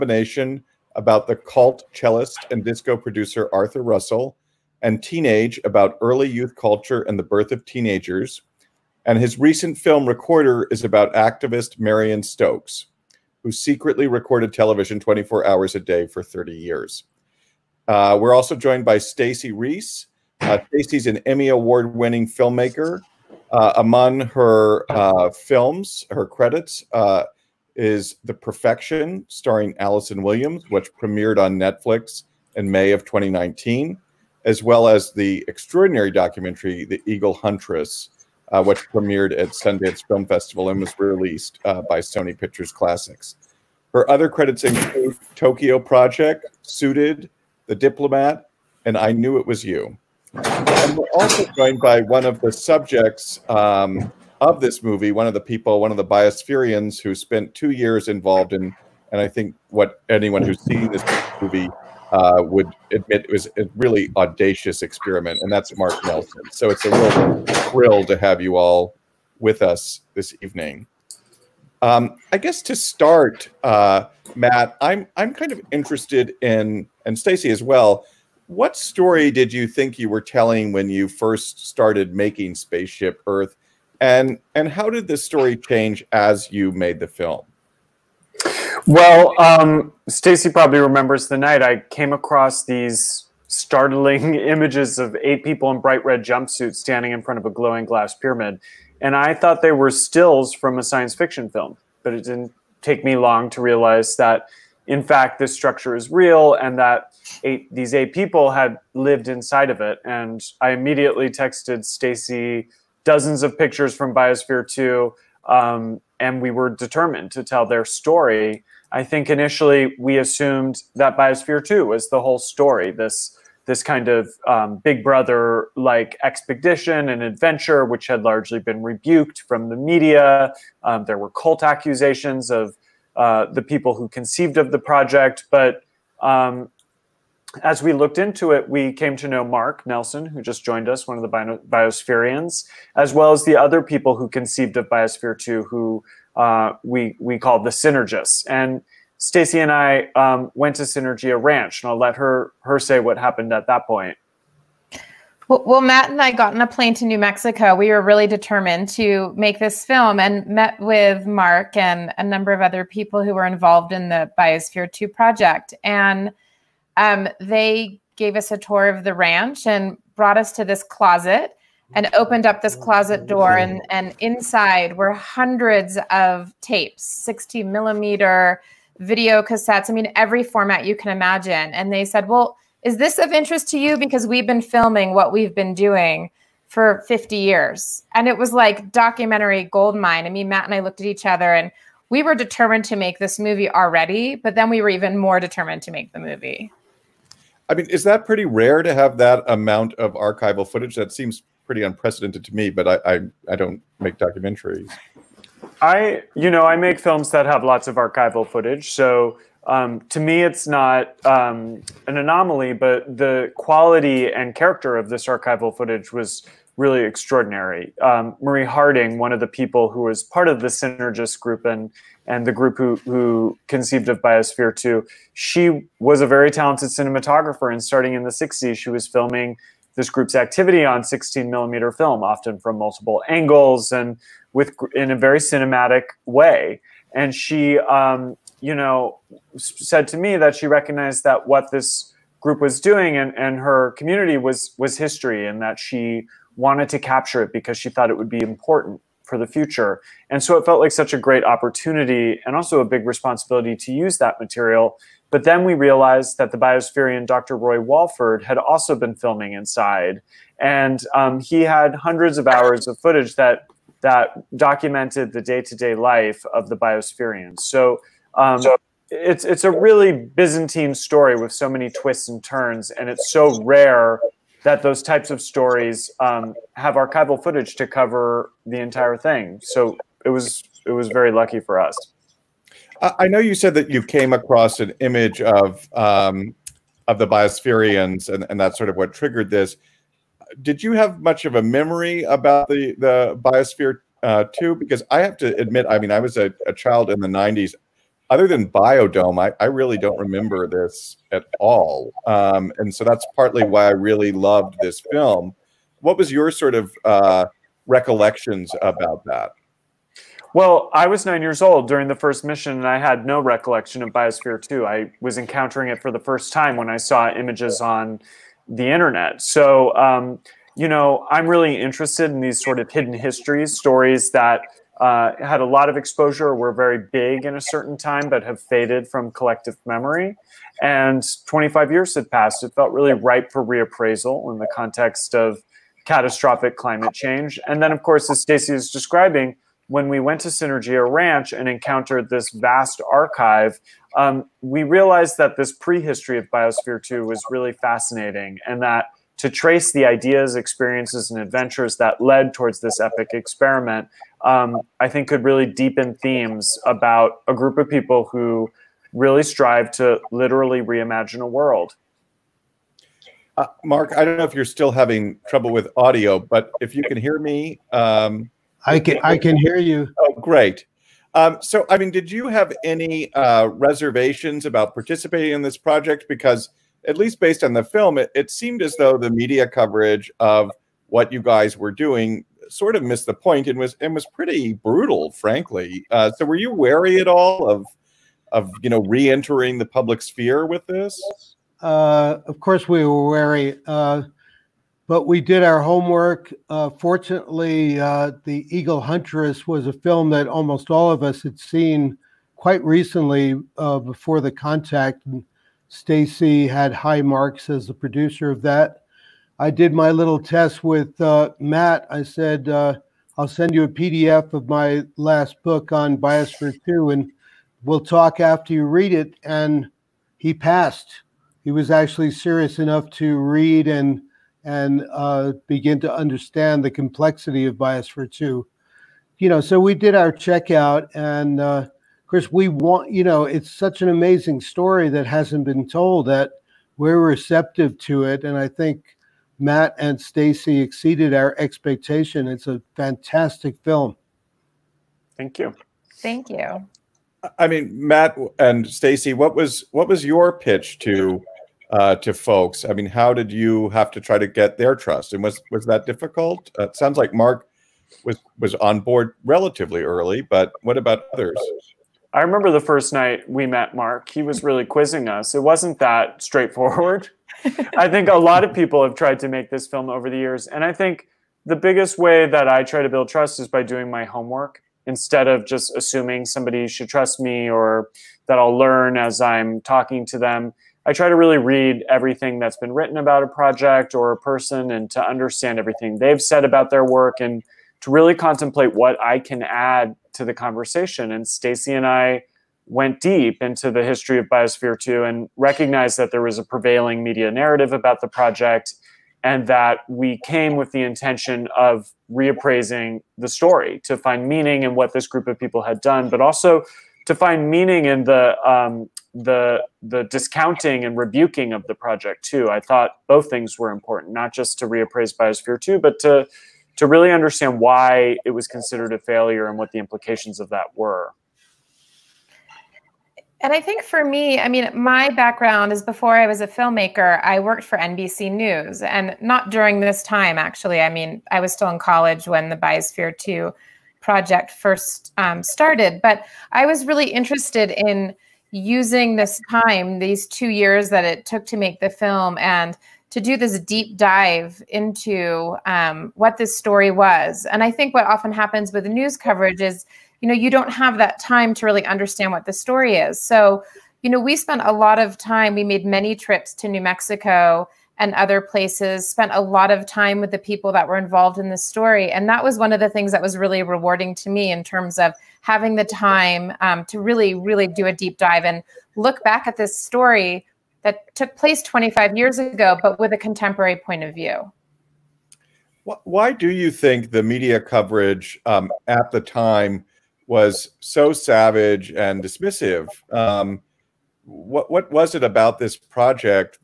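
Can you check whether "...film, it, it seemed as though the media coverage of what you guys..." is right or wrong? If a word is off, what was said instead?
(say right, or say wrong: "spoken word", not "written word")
right.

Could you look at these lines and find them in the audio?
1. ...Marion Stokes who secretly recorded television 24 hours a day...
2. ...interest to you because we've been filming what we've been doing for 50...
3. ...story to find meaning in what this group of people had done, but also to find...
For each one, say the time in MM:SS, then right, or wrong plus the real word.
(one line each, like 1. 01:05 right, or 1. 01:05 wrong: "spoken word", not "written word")
1. 00:11 right
2. 03:03 right
3. 08:23 right.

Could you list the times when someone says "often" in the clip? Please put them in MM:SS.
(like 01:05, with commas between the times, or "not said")
03:52, 09:08.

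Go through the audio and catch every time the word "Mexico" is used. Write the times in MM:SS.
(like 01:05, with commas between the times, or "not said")
02:37, 09:17.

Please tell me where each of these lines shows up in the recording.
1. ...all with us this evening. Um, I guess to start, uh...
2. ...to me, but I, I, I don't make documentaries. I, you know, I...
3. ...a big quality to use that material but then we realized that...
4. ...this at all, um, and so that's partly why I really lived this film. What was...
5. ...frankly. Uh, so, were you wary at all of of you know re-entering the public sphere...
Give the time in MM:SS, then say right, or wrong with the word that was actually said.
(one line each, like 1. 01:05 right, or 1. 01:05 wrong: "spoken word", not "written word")
1. 01:08 right
2. 03:22 right
3. 04:12 wrong: "responsibility", not "quality"
4. 05:00 wrong: "loved", not "lived"
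5. 06:25 right.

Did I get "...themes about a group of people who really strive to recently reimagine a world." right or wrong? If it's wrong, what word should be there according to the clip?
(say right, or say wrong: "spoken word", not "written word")
wrong: "literally", not "recently".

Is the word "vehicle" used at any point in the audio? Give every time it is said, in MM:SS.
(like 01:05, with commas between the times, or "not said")
not said.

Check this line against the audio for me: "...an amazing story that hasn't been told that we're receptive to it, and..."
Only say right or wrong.
right.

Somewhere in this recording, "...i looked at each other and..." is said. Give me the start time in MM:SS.
03:10.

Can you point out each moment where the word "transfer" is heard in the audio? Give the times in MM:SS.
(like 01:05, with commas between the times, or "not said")
not said.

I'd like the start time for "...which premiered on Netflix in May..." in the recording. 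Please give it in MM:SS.
00:30.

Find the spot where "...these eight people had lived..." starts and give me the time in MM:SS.
01:47.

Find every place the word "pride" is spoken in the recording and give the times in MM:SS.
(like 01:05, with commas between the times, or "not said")
not said.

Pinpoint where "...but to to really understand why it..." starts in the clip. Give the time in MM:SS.
08:35.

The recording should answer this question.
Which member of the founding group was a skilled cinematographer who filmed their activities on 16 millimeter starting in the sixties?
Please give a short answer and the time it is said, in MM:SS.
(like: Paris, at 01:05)
Marie Harding, at 03:38.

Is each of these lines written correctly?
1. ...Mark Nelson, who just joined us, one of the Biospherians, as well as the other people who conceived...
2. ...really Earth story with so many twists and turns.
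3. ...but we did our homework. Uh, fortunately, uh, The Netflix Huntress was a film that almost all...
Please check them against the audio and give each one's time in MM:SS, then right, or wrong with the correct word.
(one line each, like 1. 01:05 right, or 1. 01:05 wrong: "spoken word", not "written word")
1. 02:19 right
2. 04:29 wrong: "Byzantine", not "Earth"
3. 06:35 wrong: "Eagle", not "Netflix".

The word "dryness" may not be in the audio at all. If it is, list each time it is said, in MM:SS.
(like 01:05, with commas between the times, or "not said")
not said.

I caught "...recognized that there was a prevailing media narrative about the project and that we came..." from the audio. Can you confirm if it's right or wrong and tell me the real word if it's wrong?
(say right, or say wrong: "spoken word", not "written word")
right.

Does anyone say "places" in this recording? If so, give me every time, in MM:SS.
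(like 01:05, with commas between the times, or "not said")
09:18, 09:31.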